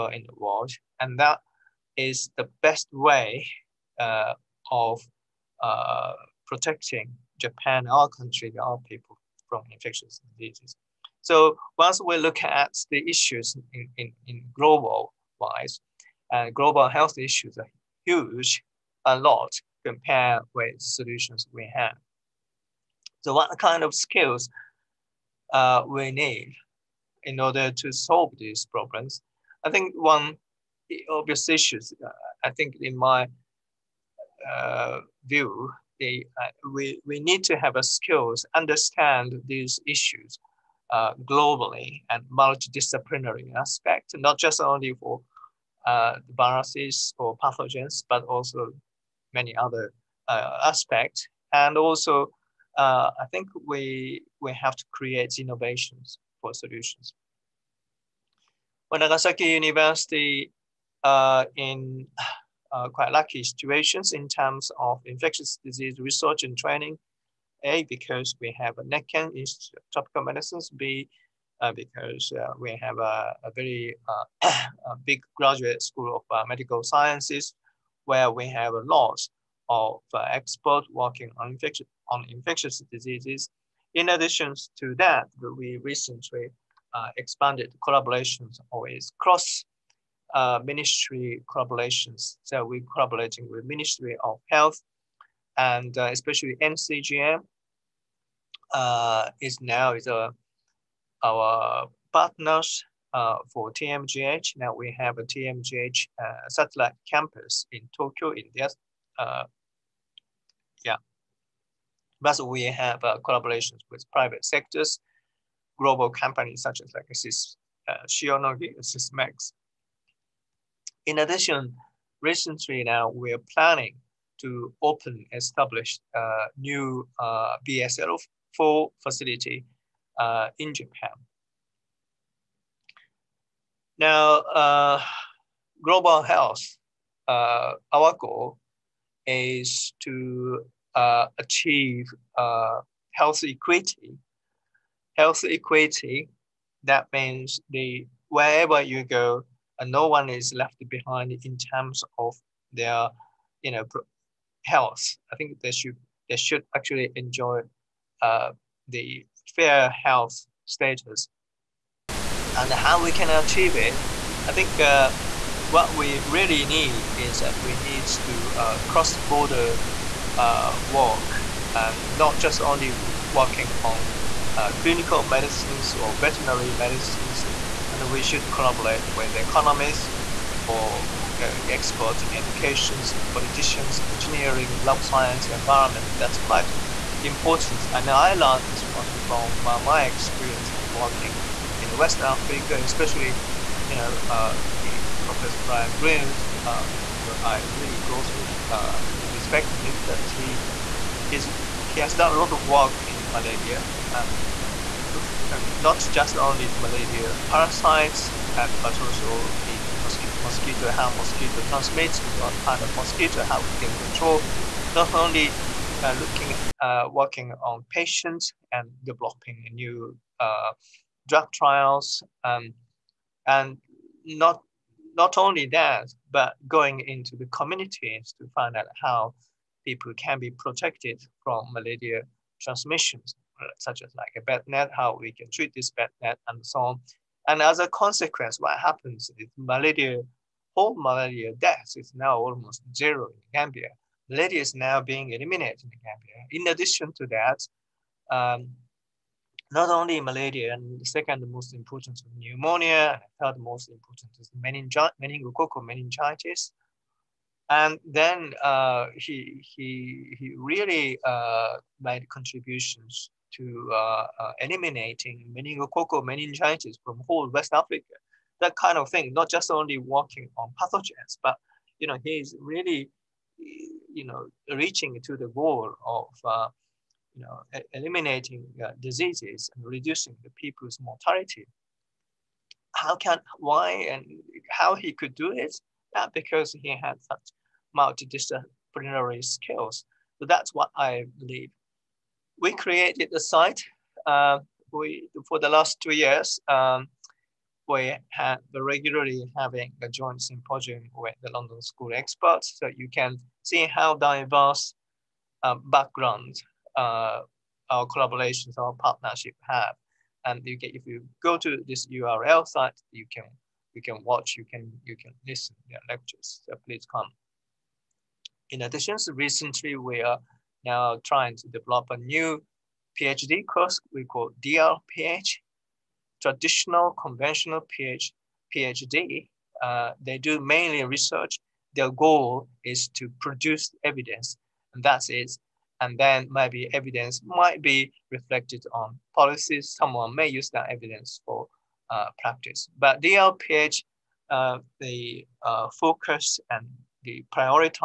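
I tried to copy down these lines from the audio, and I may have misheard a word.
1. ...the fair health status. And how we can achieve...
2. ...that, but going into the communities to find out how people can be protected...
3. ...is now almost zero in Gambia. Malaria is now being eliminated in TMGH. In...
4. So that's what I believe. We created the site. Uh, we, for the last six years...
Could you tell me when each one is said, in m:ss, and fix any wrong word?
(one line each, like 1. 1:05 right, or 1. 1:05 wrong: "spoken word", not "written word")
1. 2:38 right
2. 3:45 right
3. 4:01 wrong: "Gambia", not "TMGH"
4. 4:50 wrong: "two", not "six".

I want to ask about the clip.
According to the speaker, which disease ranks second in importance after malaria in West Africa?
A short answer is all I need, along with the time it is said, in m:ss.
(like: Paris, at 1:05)
Pneumonia, at 4:12.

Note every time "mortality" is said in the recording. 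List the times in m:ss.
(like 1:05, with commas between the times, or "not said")
4:41.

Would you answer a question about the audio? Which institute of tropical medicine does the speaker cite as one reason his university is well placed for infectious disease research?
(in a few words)
NEKKEN.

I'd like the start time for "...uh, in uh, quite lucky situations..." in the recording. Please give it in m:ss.
1:01.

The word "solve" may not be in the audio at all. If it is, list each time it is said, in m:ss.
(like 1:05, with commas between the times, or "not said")
0:27.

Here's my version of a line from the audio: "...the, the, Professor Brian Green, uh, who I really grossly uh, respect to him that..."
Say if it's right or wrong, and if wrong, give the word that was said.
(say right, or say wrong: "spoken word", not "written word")
right.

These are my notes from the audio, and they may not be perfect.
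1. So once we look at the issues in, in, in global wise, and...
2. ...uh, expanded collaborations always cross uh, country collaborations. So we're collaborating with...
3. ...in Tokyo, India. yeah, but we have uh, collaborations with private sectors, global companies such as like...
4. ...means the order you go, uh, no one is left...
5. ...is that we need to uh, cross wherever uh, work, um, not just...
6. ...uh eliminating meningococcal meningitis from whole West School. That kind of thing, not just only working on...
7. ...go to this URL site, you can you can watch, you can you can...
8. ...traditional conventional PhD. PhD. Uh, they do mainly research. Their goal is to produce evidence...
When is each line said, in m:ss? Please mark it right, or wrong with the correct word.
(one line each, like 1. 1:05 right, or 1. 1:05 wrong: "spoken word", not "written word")
1. 0:11 right
2. 1:26 wrong: "ministry", not "country"
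3. 1:47 right
4. 2:27 wrong: "wherever", not "order"
5. 2:47 wrong: "border", not "wherever"
6. 4:24 wrong: "Africa", not "School"
7. 5:11 right
8. 5:26 right.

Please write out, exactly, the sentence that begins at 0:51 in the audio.
And also, I think we, we have to create innovations for solutions.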